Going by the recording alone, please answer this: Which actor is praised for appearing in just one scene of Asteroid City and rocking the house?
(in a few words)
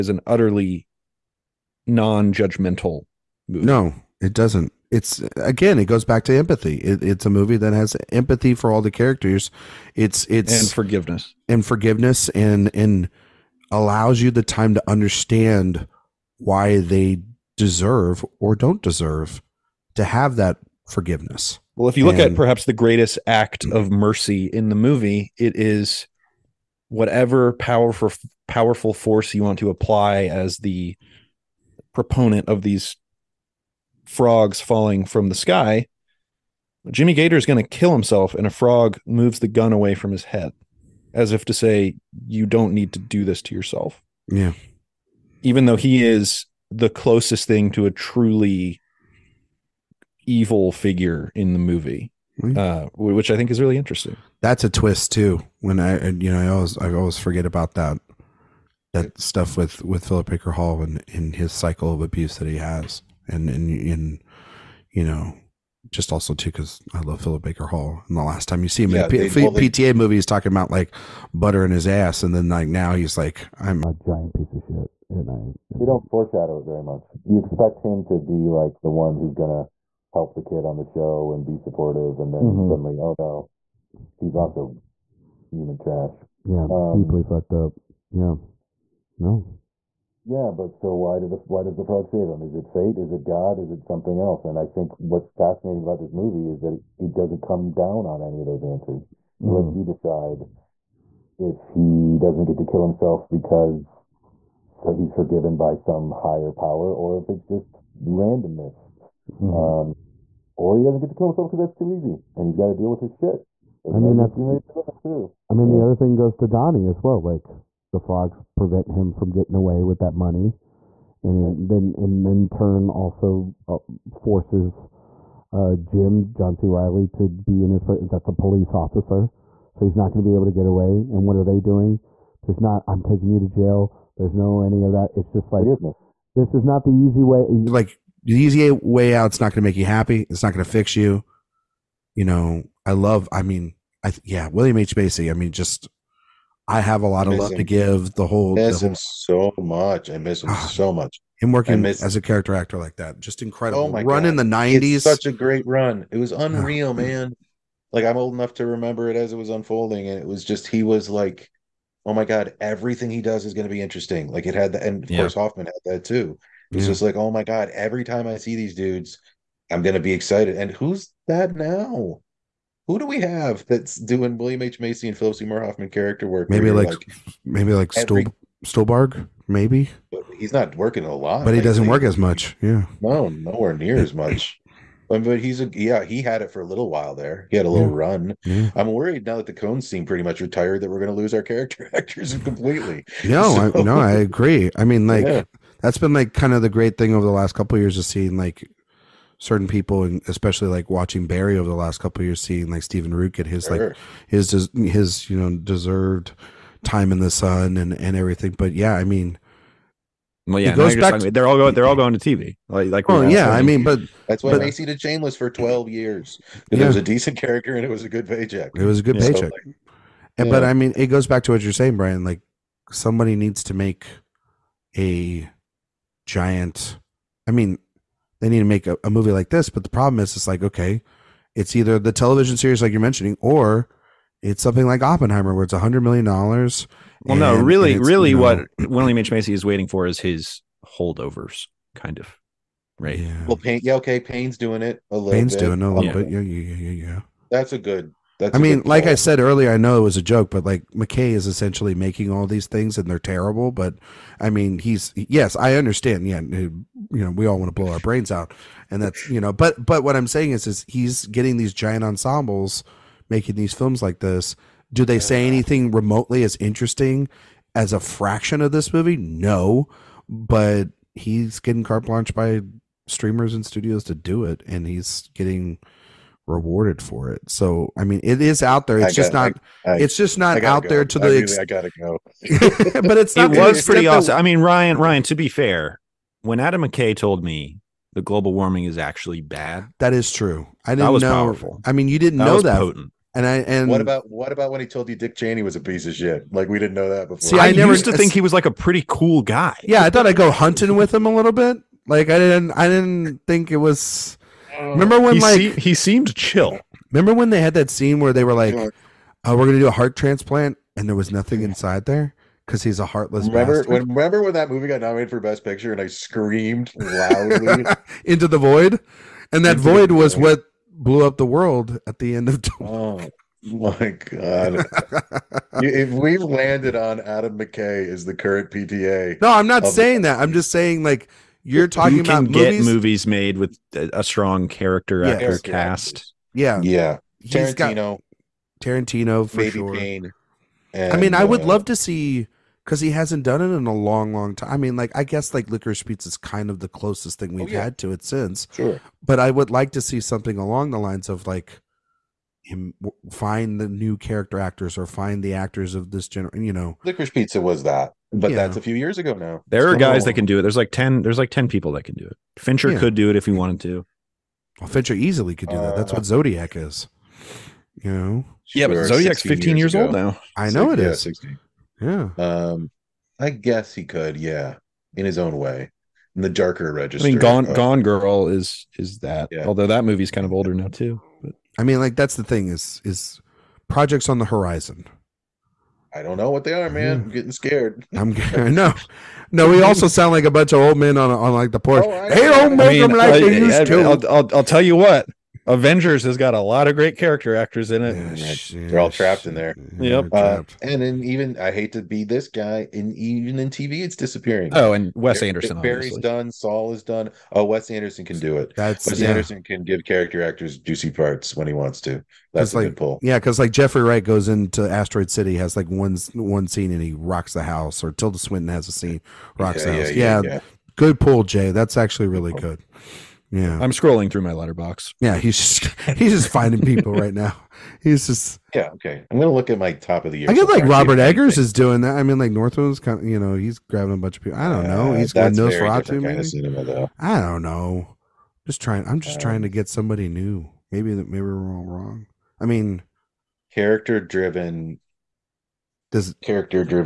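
Jeffrey Wright.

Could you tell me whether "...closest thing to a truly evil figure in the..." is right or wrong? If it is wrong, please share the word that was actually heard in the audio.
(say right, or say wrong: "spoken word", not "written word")
right.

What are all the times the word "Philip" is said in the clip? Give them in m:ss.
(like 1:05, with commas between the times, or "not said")
1:00, 1:07, 2:55.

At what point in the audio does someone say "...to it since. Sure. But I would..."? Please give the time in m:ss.
5:47.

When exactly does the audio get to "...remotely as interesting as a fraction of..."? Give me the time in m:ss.
4:25.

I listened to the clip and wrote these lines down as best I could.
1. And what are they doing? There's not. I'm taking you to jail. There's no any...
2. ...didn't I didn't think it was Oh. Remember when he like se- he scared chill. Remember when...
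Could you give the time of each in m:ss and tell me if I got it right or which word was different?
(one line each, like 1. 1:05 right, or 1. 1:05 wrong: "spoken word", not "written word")
1. 2:11 right
2. 5:02 wrong: "seemed", not "scared".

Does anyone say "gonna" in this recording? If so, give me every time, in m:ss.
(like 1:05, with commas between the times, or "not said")
1:19, 2:49, 5:09, 7:09.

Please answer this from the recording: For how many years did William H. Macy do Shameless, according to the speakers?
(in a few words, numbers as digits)
12.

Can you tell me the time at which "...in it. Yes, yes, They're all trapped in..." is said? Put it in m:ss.
6:37.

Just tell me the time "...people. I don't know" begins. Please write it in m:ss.
7:14.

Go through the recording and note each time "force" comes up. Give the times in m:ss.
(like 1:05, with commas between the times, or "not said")
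0:28, 2:04.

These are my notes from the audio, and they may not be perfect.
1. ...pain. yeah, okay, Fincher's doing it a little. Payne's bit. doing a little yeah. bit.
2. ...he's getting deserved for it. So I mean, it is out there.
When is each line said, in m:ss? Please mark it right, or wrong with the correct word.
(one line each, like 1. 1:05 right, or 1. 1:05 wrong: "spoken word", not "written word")
1. 4:03 wrong: "Pain", not "Fincher"
2. 4:34 wrong: "rewarded", not "deserved".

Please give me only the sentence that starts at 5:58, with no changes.
that's a few years ago now.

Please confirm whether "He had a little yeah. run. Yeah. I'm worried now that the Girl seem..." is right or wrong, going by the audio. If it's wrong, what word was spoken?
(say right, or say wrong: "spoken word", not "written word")
wrong: "Coens", not "Girl".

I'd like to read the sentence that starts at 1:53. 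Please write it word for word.
There's I mean, that's that too.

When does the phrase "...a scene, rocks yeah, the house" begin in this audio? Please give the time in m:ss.
6:58.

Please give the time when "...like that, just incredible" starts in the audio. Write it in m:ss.
2:32.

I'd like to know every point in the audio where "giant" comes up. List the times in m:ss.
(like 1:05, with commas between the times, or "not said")
1:13, 3:46, 4:21.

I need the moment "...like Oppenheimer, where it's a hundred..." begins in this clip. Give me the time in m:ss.
3:54.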